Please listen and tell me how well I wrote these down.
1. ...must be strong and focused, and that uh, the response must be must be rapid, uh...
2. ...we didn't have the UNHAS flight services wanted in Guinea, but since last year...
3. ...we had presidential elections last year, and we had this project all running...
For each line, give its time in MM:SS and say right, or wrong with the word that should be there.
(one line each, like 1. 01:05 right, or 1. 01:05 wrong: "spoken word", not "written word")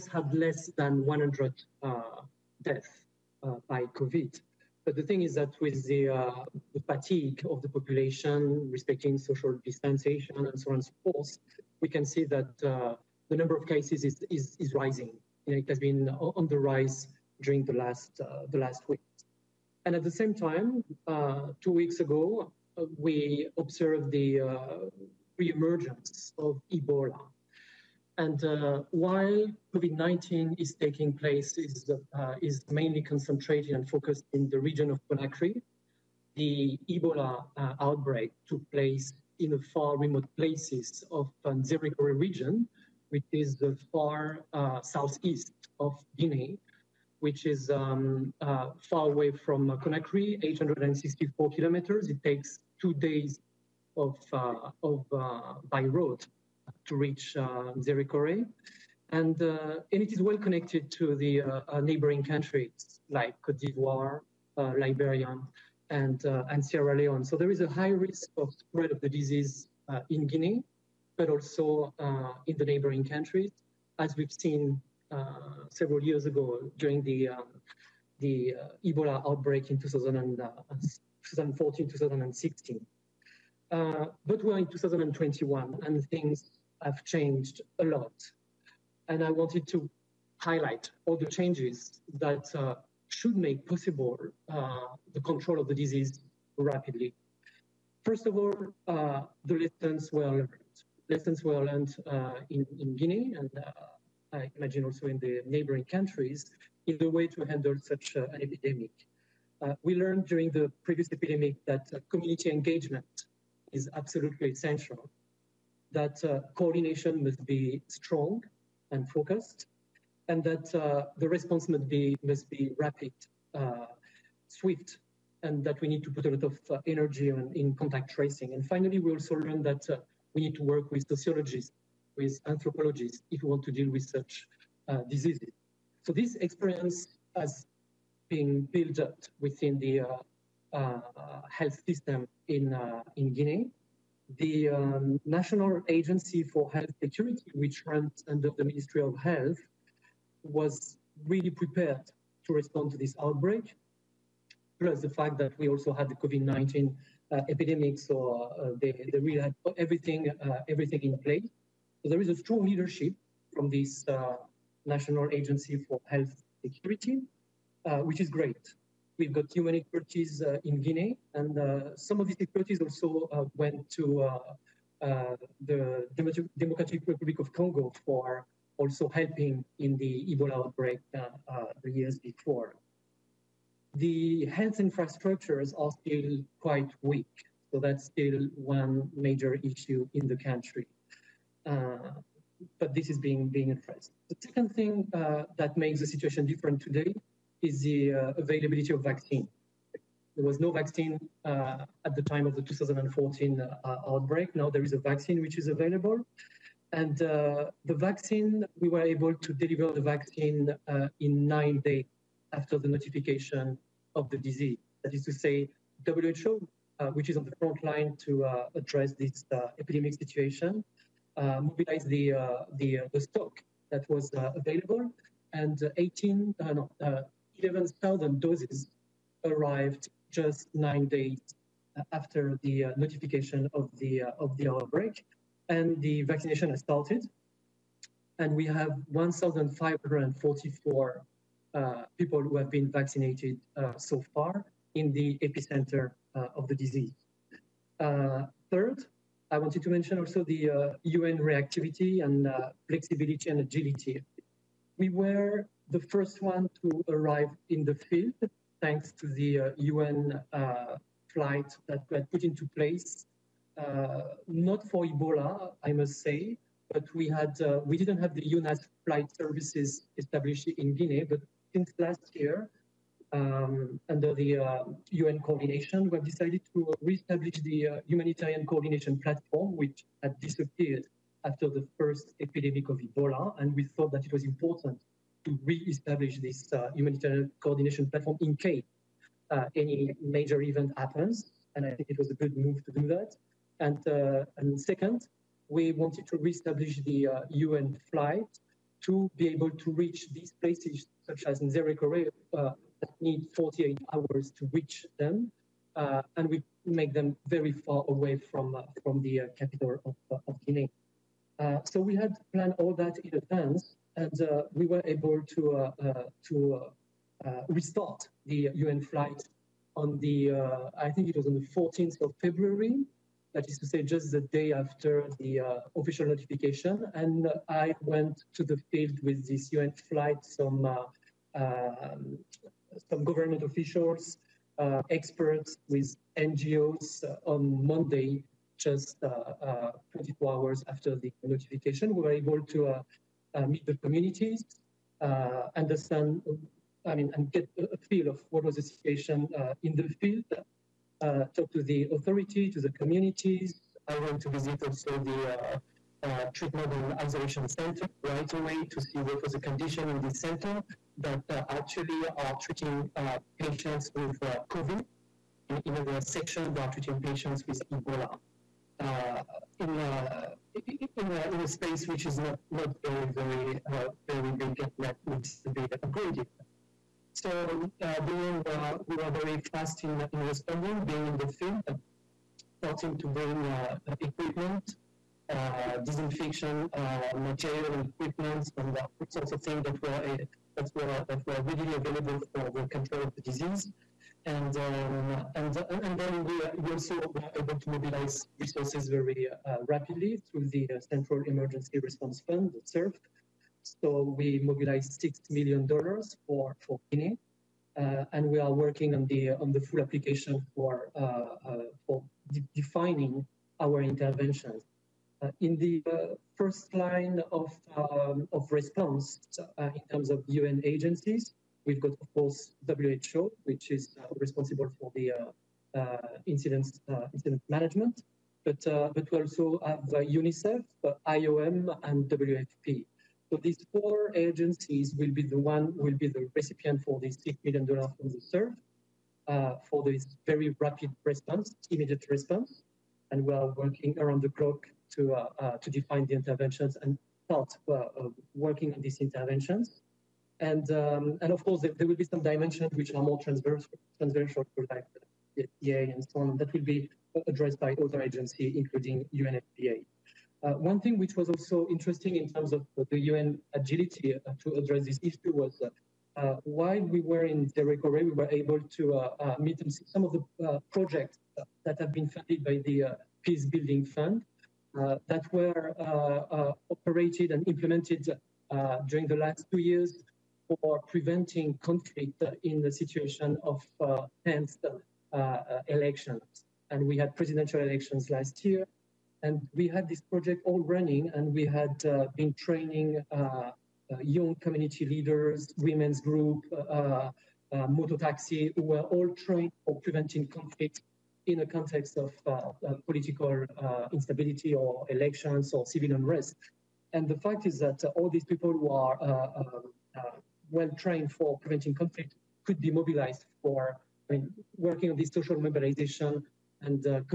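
1. 01:57 right
2. 04:27 wrong: "established", not "wanted"
3. 08:07 right.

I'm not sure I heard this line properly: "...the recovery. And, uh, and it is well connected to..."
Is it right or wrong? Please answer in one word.
right.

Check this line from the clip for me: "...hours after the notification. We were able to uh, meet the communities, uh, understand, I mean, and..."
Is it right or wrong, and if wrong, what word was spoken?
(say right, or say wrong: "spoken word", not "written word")
right.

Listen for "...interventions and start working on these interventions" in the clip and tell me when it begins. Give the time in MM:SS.
07:26.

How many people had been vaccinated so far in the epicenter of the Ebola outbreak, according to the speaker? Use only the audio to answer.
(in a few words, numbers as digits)
1,544.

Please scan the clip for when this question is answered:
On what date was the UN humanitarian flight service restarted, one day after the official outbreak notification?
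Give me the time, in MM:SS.
05:21.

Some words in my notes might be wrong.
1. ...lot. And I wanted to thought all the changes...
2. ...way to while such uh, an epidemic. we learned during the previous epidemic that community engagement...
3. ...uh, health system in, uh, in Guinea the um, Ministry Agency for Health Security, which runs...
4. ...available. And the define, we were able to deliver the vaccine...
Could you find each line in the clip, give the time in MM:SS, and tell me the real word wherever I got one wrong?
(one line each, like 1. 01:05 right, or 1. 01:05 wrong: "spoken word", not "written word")
1. 01:27 wrong: "highlight", not "thought"
2. 01:47 wrong: "handle", not "while"
3. 02:20 wrong: "National", not "Ministry"
4. 03:25 wrong: "vaccine", not "define".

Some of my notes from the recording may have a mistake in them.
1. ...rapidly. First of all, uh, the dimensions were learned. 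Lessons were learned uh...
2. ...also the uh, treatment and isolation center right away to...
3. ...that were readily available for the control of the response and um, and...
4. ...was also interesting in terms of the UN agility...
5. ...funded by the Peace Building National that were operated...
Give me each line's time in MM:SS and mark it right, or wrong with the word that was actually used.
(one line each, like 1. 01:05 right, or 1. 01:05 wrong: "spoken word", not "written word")
1. 01:36 wrong: "lessons", not "dimensions"
2. 05:54 right
3. 06:31 wrong: "disease", not "response"
4. 07:41 right
5. 07:52 wrong: "Fund", not "National".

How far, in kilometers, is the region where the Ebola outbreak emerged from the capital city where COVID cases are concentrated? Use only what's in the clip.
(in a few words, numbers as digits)
864 kilometers.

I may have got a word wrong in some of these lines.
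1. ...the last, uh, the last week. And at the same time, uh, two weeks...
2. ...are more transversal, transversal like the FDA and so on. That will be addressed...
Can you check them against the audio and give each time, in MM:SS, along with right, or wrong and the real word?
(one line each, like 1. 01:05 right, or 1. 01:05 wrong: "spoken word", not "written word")
1. 00:17 right
2. 07:33 right.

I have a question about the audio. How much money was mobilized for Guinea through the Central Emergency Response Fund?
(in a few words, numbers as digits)
$6 million.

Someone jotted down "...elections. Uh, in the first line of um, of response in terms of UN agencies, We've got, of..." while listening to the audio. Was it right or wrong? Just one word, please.
wrong.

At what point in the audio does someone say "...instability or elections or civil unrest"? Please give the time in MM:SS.
08:24.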